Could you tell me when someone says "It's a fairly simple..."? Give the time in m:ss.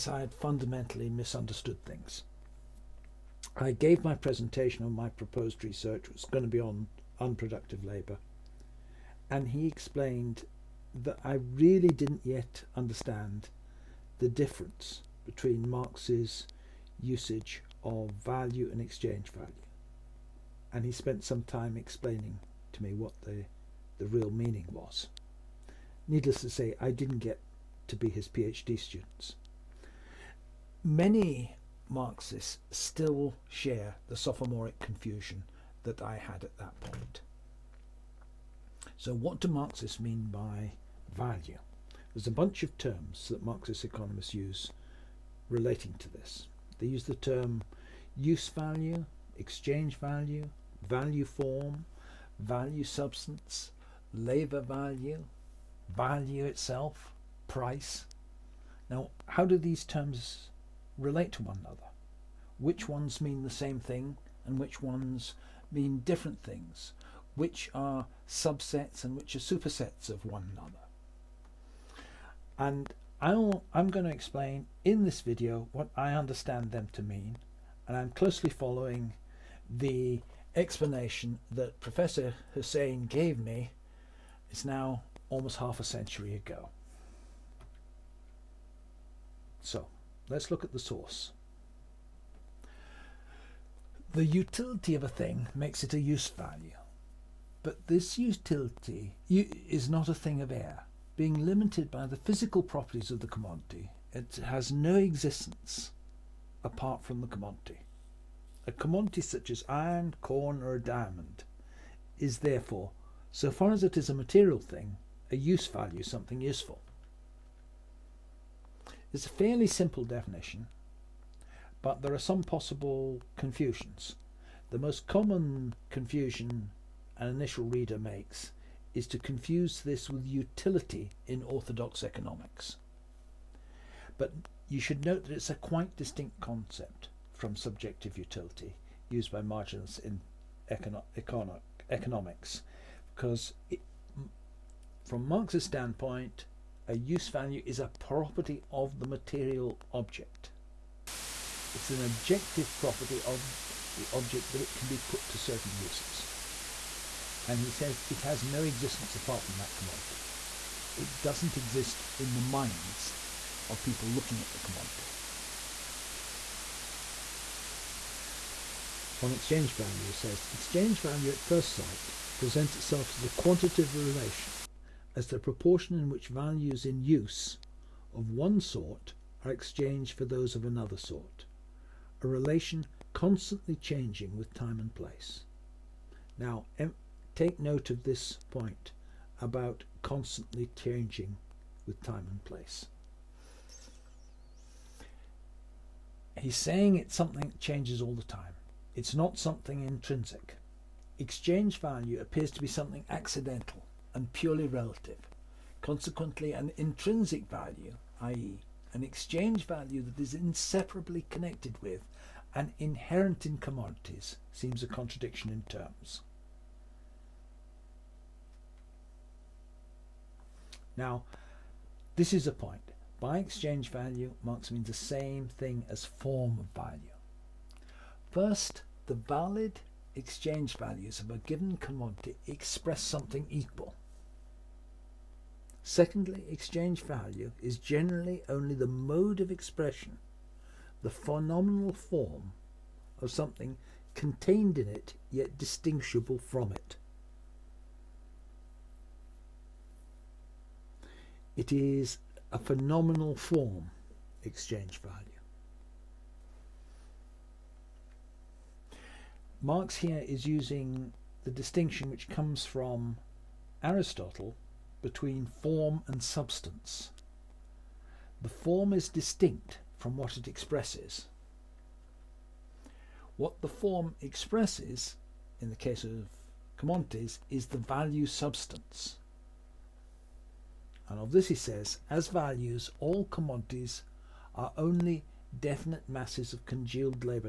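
1:59.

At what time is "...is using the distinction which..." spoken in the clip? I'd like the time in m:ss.
4:20.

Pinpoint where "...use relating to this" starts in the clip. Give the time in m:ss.
0:44.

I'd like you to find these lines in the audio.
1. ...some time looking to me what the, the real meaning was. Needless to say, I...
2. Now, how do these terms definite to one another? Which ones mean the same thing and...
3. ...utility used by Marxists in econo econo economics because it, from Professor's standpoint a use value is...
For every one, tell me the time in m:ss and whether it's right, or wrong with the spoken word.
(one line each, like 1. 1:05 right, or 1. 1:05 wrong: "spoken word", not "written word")
1. 0:21 wrong: "explaining", not "looking"
2. 0:58 wrong: "relate", not "definite"
3. 2:18 wrong: "Marx", not "Professor".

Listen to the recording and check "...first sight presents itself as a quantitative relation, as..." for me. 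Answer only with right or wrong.
right.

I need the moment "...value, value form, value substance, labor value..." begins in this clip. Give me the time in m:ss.
0:49.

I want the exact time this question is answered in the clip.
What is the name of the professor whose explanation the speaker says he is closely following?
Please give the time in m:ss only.
1:21.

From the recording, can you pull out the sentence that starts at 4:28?
The form is distinct from what it expresses.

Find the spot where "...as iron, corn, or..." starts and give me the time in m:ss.
1:49.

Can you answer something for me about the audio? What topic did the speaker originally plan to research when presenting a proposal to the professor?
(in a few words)
Unproductive labour.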